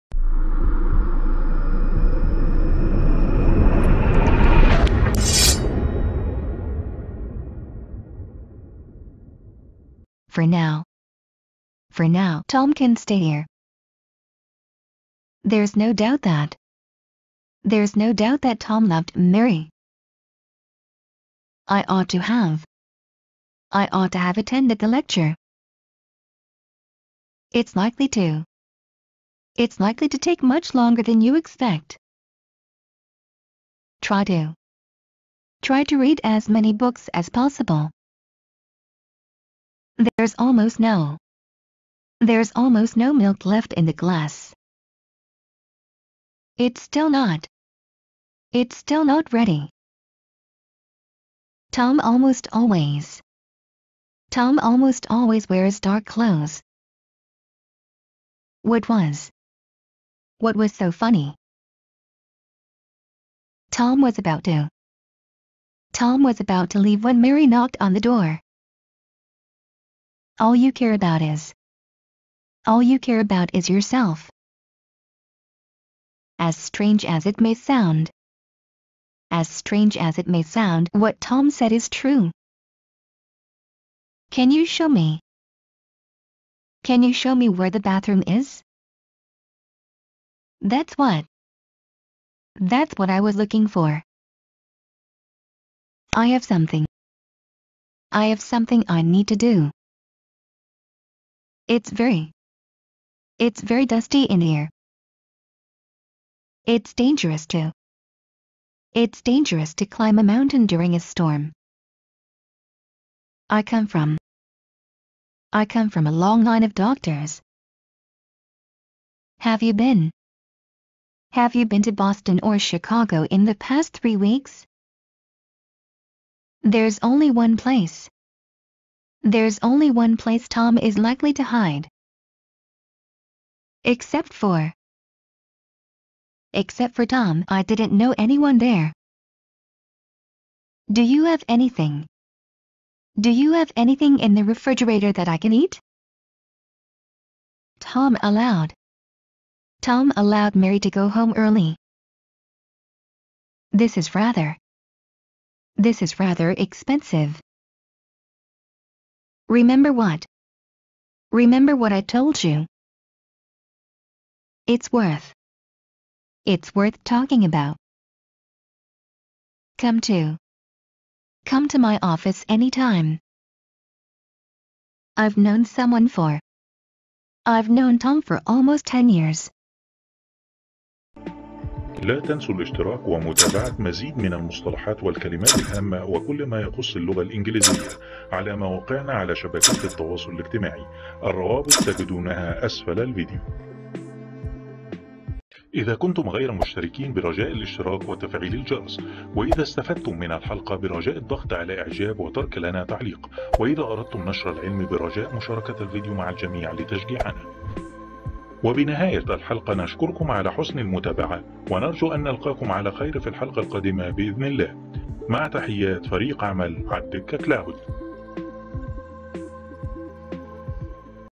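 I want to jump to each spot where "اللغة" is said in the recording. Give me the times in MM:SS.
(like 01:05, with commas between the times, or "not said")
03:06.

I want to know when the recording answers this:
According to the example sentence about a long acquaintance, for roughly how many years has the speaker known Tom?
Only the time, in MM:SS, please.
02:58.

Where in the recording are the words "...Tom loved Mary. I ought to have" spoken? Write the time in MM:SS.
00:18.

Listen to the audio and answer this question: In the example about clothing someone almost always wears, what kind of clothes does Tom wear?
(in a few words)
dark clothes.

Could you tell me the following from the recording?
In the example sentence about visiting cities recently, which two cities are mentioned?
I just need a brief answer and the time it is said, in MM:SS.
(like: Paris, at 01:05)
Boston or Chicago, at 02:01.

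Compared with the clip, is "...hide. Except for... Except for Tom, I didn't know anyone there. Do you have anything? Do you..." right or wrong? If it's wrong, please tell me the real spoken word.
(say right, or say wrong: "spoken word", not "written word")
right.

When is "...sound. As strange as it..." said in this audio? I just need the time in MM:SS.
01:17.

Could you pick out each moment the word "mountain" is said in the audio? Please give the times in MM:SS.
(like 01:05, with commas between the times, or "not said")
01:50.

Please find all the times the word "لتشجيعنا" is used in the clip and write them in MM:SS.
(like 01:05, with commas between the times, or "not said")
03:26.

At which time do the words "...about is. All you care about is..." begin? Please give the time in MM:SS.
01:10.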